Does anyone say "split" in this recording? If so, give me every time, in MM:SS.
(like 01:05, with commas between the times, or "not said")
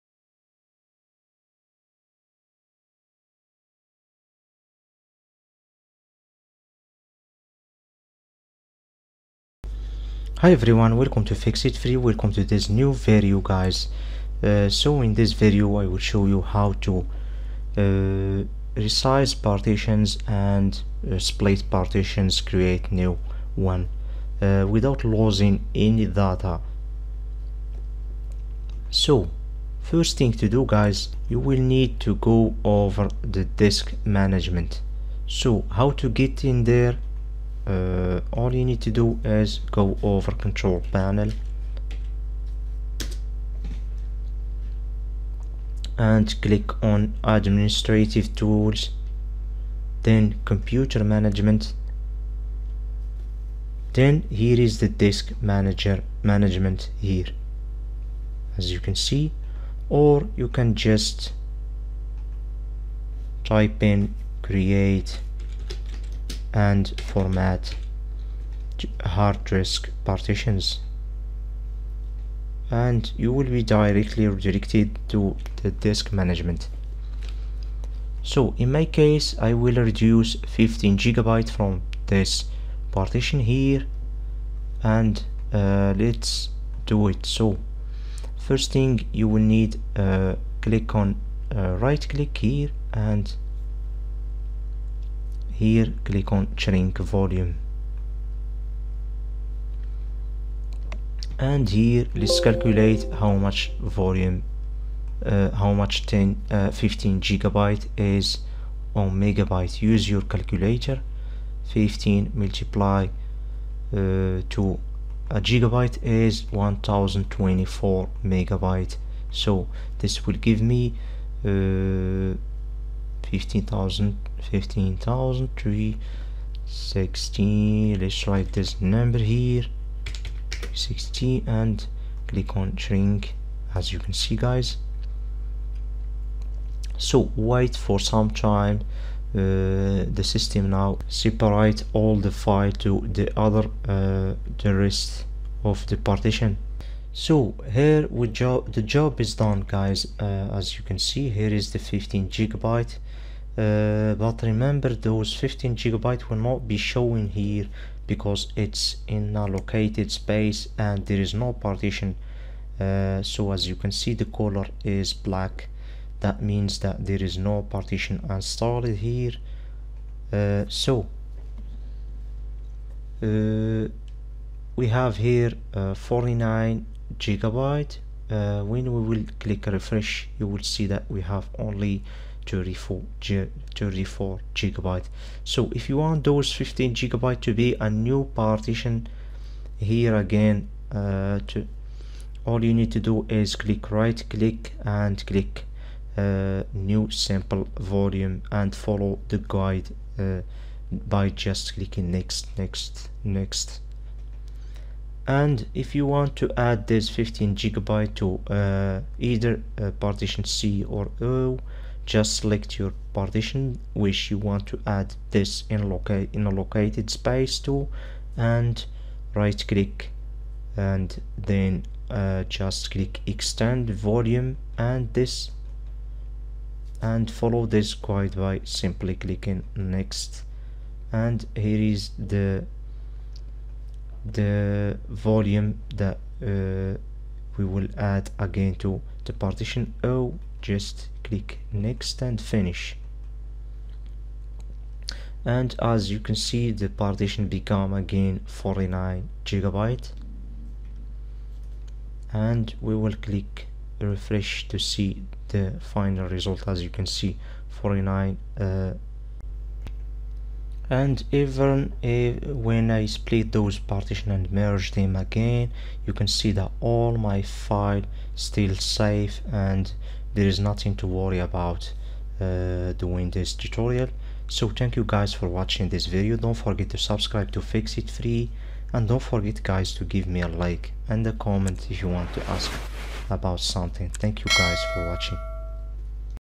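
00:21, 04:23.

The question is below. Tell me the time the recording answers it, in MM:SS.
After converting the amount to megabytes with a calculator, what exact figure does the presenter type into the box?
02:04.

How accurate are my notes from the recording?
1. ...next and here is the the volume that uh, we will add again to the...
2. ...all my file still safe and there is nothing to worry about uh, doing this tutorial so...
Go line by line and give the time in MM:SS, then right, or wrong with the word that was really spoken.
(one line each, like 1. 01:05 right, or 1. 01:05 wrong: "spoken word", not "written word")
1. 03:49 right
2. 04:26 right.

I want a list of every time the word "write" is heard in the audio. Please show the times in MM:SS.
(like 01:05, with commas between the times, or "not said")
02:08.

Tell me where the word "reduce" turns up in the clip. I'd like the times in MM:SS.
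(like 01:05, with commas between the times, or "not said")
01:19.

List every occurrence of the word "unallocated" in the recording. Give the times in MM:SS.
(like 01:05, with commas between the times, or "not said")
02:39, 03:35.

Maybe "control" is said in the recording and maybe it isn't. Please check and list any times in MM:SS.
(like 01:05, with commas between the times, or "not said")
00:40.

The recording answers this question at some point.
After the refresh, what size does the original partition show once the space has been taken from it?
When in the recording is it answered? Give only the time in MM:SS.
03:02.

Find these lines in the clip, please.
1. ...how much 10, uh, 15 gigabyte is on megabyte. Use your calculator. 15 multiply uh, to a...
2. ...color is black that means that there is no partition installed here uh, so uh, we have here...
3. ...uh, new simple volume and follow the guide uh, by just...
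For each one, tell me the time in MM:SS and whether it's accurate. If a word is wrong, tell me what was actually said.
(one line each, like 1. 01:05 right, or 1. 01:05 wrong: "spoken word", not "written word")
1. 01:45 right
2. 02:44 right
3. 03:16 right.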